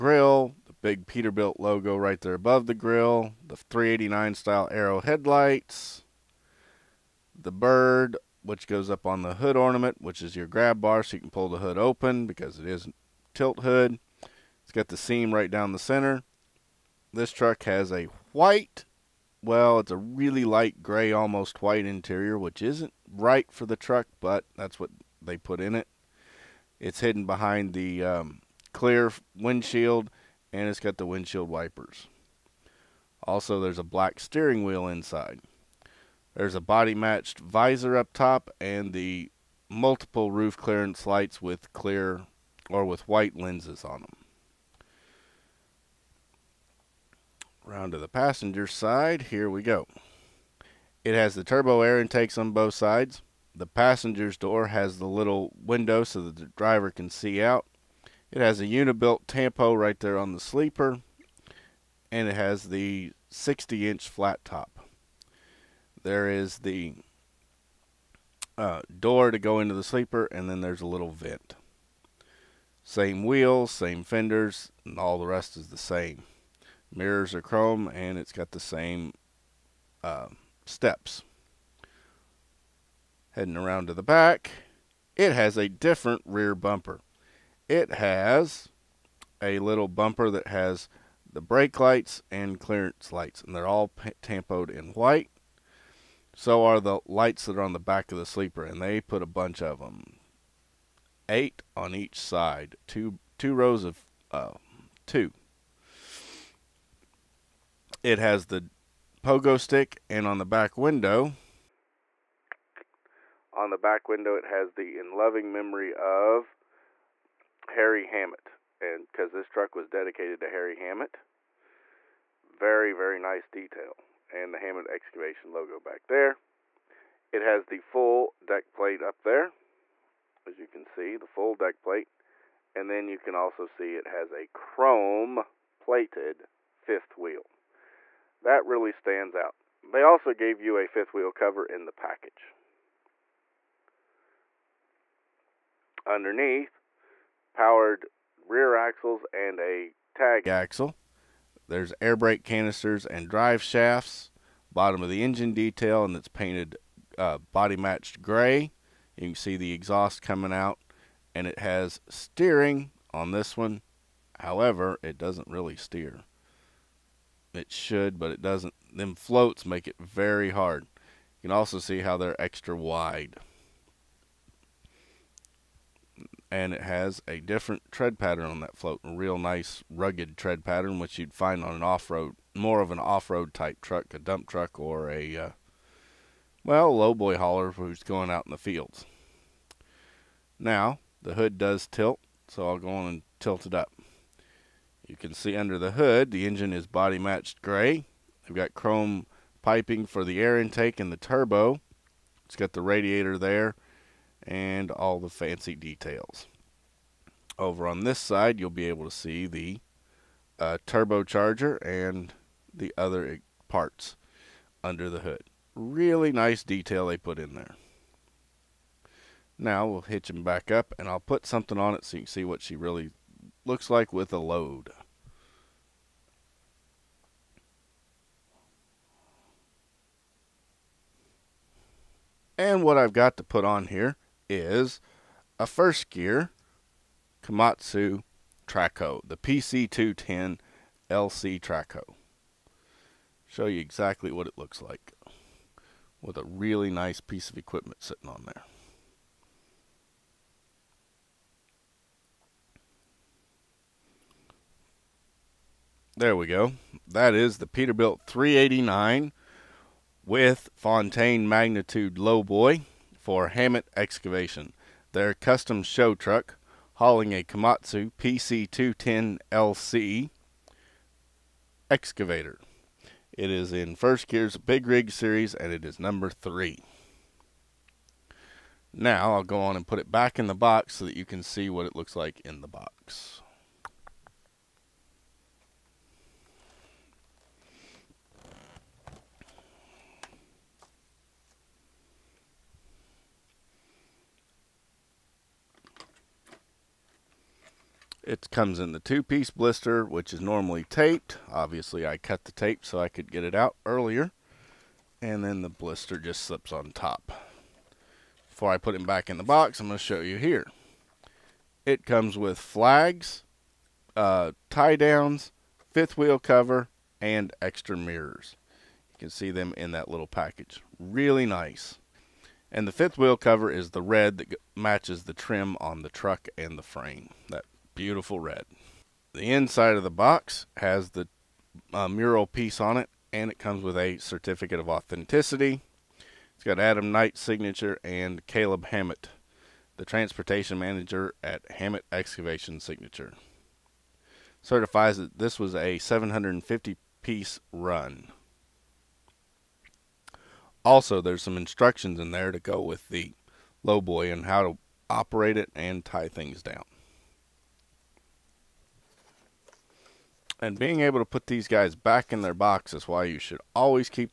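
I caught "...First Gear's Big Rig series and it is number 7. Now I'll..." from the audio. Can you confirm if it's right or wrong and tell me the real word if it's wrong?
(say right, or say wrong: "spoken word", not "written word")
wrong: "3", not "7".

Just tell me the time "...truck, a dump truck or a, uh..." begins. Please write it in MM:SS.
03:03.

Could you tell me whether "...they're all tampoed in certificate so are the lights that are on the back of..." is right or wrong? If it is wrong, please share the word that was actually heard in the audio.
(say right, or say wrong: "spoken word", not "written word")
wrong: "white", not "certificate".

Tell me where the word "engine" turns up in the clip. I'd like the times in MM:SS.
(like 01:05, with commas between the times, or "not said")
02:35, 03:16.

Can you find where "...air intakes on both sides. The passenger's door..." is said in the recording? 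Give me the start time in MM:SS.
00:51.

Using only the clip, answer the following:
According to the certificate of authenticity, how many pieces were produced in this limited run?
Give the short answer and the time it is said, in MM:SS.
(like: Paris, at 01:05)
750, at 05:45.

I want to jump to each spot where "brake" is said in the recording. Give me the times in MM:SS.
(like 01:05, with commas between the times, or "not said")
01:31, 02:32.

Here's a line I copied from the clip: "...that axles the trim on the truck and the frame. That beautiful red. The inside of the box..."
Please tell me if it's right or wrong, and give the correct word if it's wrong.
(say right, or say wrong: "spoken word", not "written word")
wrong: "matches", not "axles".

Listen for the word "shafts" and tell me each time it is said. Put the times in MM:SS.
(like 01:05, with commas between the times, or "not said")
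02:33.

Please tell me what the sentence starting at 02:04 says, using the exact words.
And the Hammett excavation logo back there.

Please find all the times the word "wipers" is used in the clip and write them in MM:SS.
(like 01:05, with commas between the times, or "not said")
00:31.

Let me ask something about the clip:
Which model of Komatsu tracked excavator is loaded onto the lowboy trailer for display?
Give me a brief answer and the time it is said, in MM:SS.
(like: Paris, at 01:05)
PC210 LC, at 03:59.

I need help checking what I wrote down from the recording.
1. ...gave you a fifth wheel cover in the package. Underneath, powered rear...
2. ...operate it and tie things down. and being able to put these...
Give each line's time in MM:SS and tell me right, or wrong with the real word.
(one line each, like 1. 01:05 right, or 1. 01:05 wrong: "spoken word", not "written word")
1. 02:20 right
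2. 05:55 right.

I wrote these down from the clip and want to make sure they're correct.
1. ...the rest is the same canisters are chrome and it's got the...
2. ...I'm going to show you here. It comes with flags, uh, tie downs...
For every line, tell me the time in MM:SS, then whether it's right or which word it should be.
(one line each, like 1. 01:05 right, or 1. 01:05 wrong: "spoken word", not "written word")
1. 01:15 wrong: "mirrors", not "canisters"
2. 05:09 right.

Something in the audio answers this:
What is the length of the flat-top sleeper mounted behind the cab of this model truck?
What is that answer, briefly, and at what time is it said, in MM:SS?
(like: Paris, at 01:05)
60 inch, at 01:03.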